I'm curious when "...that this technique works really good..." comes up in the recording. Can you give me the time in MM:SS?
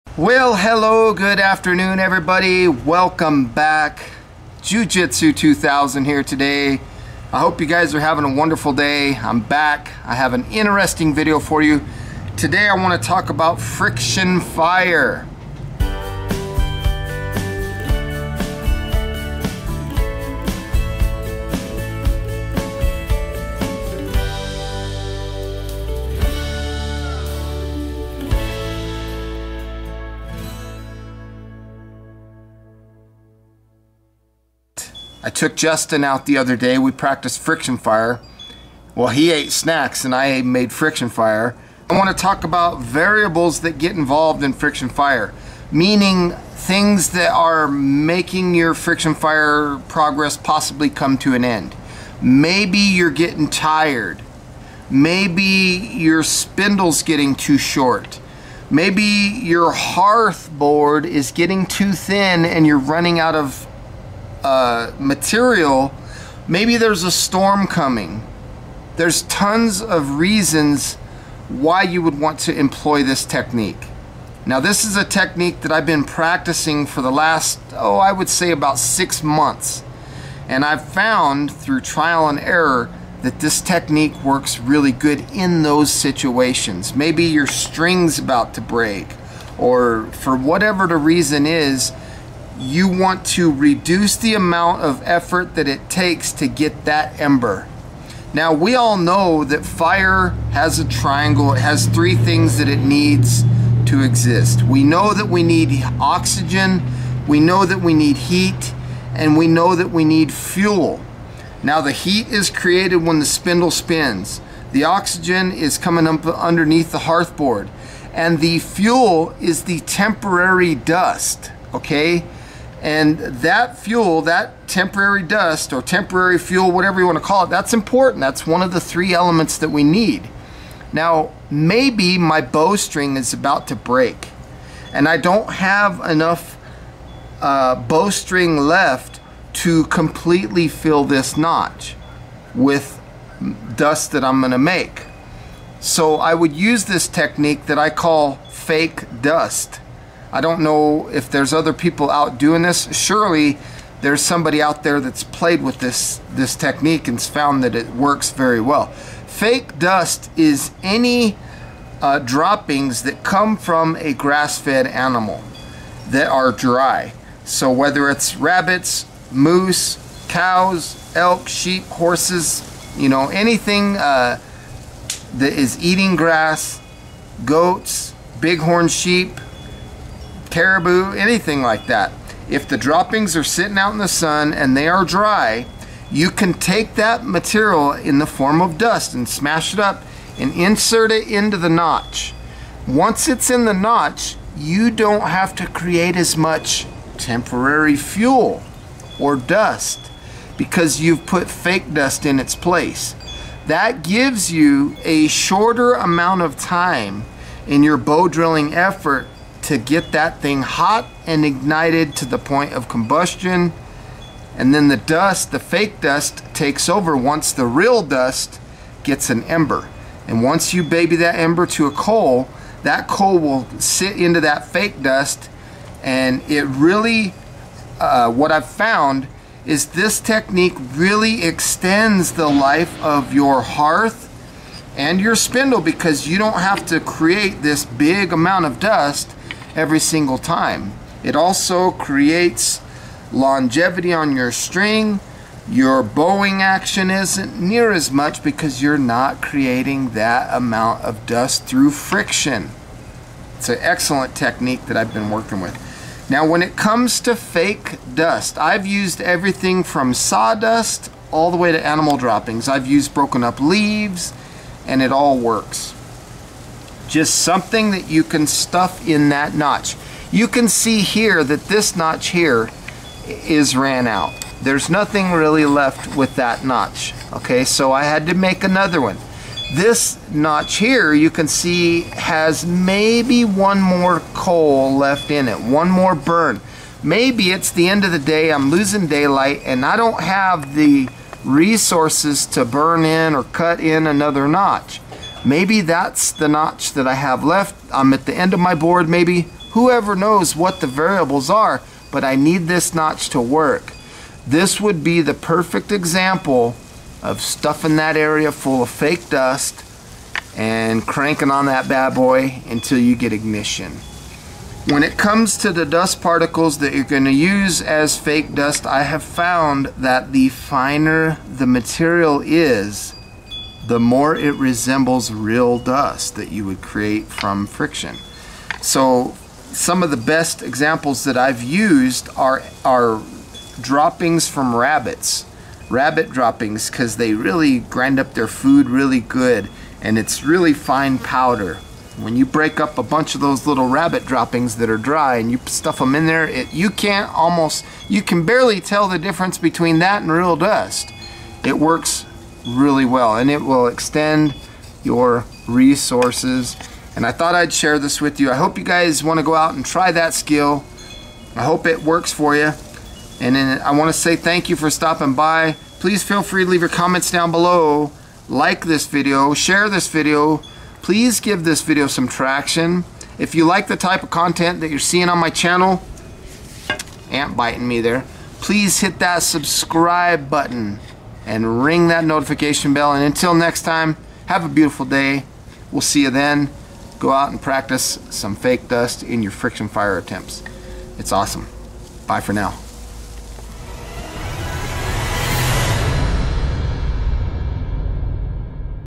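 01:23.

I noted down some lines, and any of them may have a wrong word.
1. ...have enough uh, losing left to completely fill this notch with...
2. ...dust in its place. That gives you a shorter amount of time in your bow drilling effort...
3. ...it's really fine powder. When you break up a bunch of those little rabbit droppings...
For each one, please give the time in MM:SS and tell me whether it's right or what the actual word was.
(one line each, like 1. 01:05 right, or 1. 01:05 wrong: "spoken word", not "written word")
1. 02:15 wrong: "bowstring", not "losing"
2. 03:21 right
3. 05:40 right.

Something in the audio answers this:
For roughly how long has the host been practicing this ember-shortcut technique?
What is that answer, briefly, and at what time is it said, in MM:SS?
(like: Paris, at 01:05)
6 months, at 01:18.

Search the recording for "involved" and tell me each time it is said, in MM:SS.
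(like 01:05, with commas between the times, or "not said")
00:43.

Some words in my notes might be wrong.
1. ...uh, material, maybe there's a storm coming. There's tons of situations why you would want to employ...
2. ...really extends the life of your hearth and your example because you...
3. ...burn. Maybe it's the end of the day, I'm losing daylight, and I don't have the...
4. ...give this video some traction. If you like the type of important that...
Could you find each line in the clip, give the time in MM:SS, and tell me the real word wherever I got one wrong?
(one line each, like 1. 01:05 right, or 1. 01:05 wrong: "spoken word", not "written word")
1. 01:04 wrong: "reasons", not "situations"
2. 03:50 wrong: "spindle", not "example"
3. 04:46 right
4. 06:11 wrong: "content", not "important".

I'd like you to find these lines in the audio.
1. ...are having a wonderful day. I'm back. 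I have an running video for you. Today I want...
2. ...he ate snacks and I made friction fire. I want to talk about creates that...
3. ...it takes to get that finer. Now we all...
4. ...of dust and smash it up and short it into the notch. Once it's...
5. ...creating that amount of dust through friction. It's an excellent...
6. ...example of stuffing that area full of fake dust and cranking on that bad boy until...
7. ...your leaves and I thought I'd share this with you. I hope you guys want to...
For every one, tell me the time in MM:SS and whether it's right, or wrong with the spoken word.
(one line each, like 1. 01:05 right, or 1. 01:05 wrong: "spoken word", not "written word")
1. 00:07 wrong: "interesting", not "running"
2. 00:39 wrong: "variables", not "creates"
3. 01:35 wrong: "ember", not "finer"
4. 03:08 wrong: "insert", not "short"
5. 04:09 right
6. 05:05 right
7. 05:55 wrong: "resources", not "leaves".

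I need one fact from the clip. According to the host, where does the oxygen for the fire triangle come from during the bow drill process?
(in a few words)
underneath the hearthboard.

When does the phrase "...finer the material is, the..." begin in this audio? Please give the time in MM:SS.
05:20.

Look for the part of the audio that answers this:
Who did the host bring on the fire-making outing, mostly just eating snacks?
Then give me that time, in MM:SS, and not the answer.
00:35.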